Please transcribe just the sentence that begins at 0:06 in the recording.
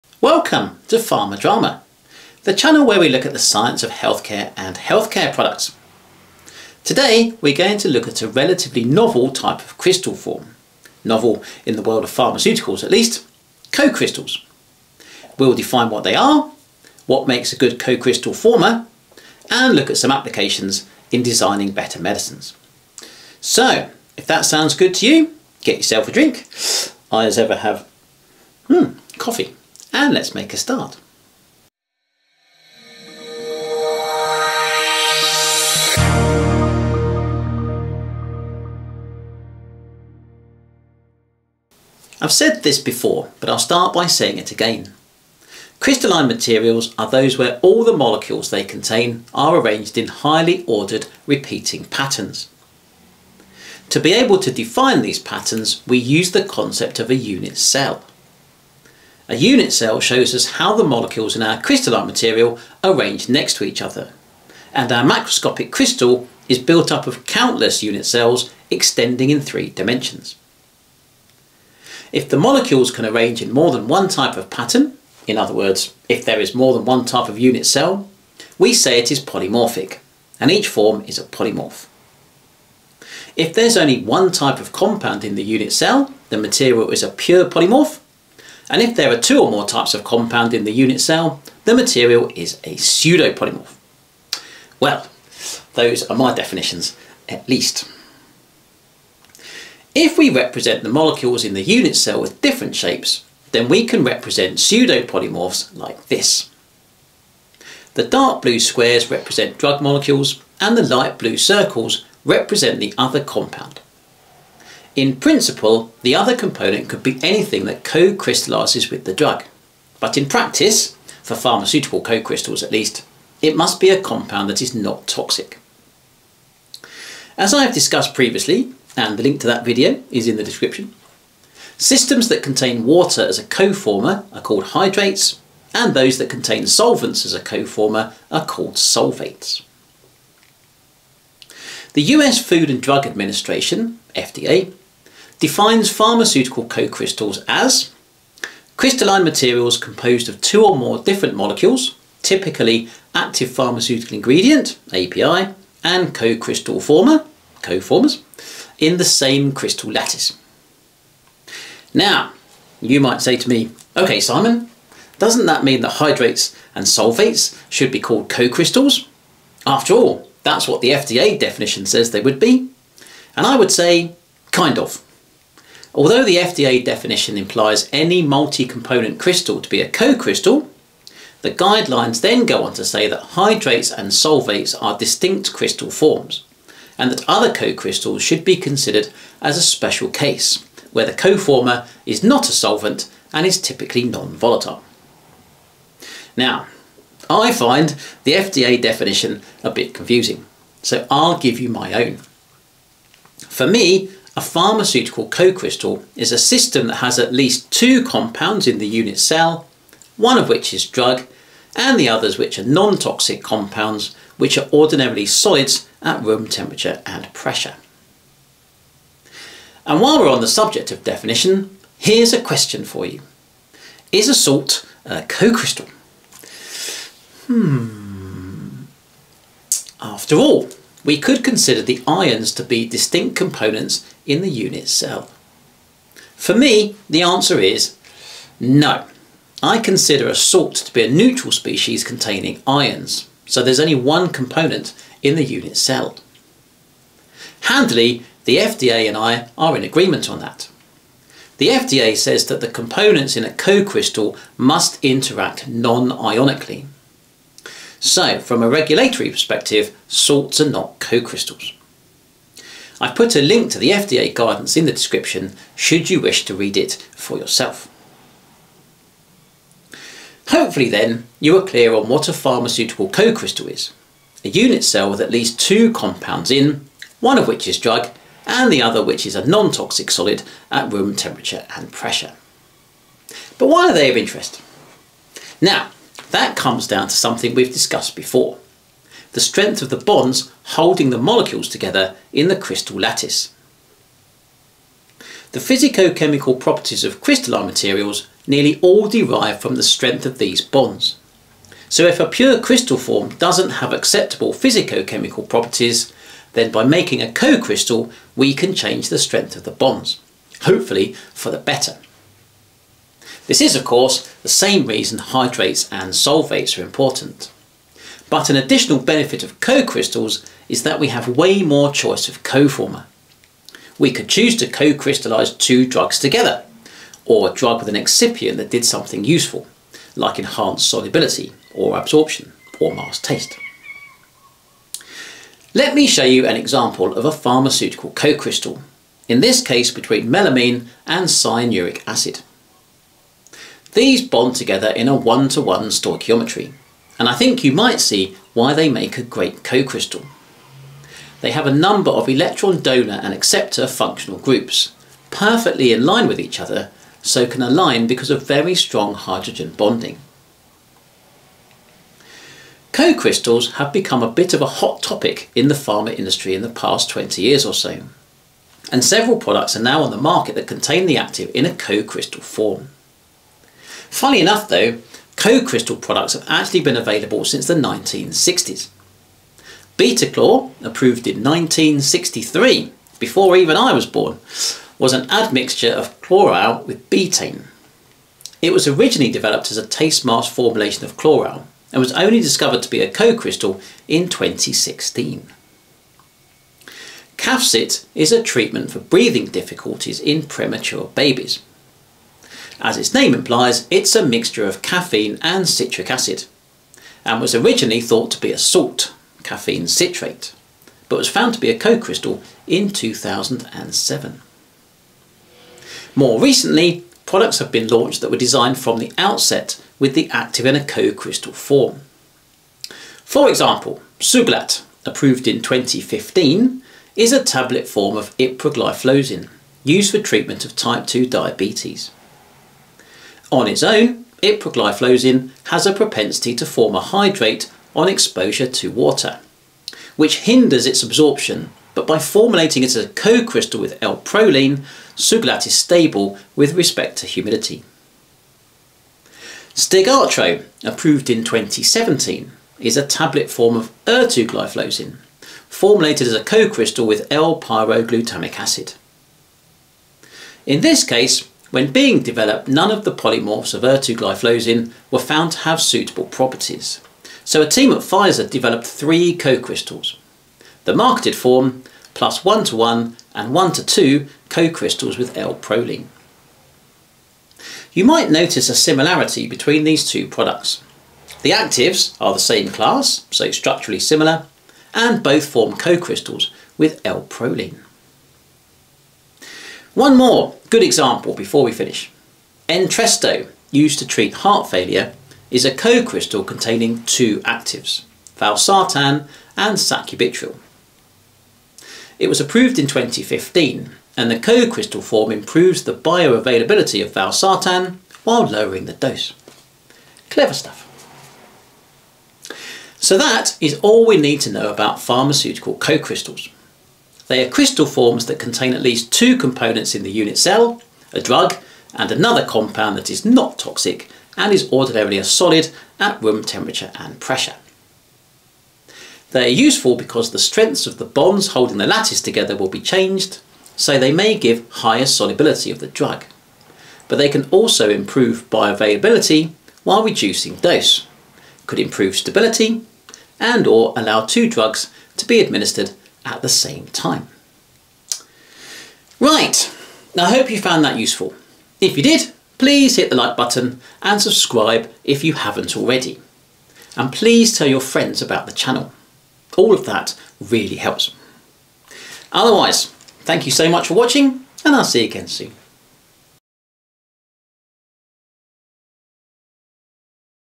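Today we're going to look at a relatively novel type of crystal form, novel in the world of pharmaceuticals at least, co-crystals.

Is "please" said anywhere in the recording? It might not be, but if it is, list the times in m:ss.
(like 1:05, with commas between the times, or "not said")
9:12, 9:17.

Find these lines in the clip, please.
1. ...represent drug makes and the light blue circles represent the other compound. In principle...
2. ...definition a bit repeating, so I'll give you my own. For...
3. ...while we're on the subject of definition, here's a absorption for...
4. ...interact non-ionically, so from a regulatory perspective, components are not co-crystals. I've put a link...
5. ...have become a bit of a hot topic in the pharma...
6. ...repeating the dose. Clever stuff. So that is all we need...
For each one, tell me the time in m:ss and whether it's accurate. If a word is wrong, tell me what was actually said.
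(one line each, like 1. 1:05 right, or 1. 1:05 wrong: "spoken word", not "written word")
1. 1:49 wrong: "molecules", not "makes"
2. 3:18 wrong: "confusing", not "repeating"
3. 3:40 wrong: "question", not "absorption"
4. 4:15 wrong: "salts", not "components"
5. 6:03 right
6. 8:28 wrong: "lowering", not "repeating".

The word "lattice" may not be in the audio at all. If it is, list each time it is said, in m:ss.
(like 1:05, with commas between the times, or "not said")
2:39, 4:52, 8:51.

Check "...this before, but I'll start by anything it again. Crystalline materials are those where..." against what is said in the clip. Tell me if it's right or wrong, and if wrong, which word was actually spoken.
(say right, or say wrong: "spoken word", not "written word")
wrong: "saying", not "anything".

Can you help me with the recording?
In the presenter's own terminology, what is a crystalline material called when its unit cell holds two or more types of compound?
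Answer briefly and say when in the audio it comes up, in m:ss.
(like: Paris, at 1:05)
Pseudopolymorph, at 1:32.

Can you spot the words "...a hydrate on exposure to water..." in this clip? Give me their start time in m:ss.
7:16.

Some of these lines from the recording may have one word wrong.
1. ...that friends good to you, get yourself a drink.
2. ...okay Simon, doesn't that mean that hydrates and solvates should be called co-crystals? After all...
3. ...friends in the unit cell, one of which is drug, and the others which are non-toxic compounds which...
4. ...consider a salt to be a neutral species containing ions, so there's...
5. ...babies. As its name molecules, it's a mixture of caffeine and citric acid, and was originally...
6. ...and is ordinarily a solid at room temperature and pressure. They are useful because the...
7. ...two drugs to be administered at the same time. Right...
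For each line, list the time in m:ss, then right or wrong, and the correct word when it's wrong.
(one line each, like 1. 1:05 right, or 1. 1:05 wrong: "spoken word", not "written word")
1. 0:24 wrong: "sounds", not "friends"
2. 2:43 right
3. 3:28 wrong: "compounds", not "friends"
4. 3:59 right
5. 6:41 wrong: "implies", not "molecules"
6. 8:44 right
7. 9:04 right.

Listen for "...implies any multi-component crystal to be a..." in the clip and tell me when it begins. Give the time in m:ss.
2:57.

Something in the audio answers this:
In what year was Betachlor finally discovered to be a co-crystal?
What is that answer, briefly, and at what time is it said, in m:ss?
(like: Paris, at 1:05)
2016, at 6:34.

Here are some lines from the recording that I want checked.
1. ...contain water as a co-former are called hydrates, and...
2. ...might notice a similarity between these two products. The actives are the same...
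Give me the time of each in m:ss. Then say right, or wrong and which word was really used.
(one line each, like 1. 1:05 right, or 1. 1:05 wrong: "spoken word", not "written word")
1. 2:12 right
2. 7:58 right.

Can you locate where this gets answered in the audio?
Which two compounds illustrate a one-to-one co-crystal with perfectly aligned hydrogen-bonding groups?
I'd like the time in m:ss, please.
5:40.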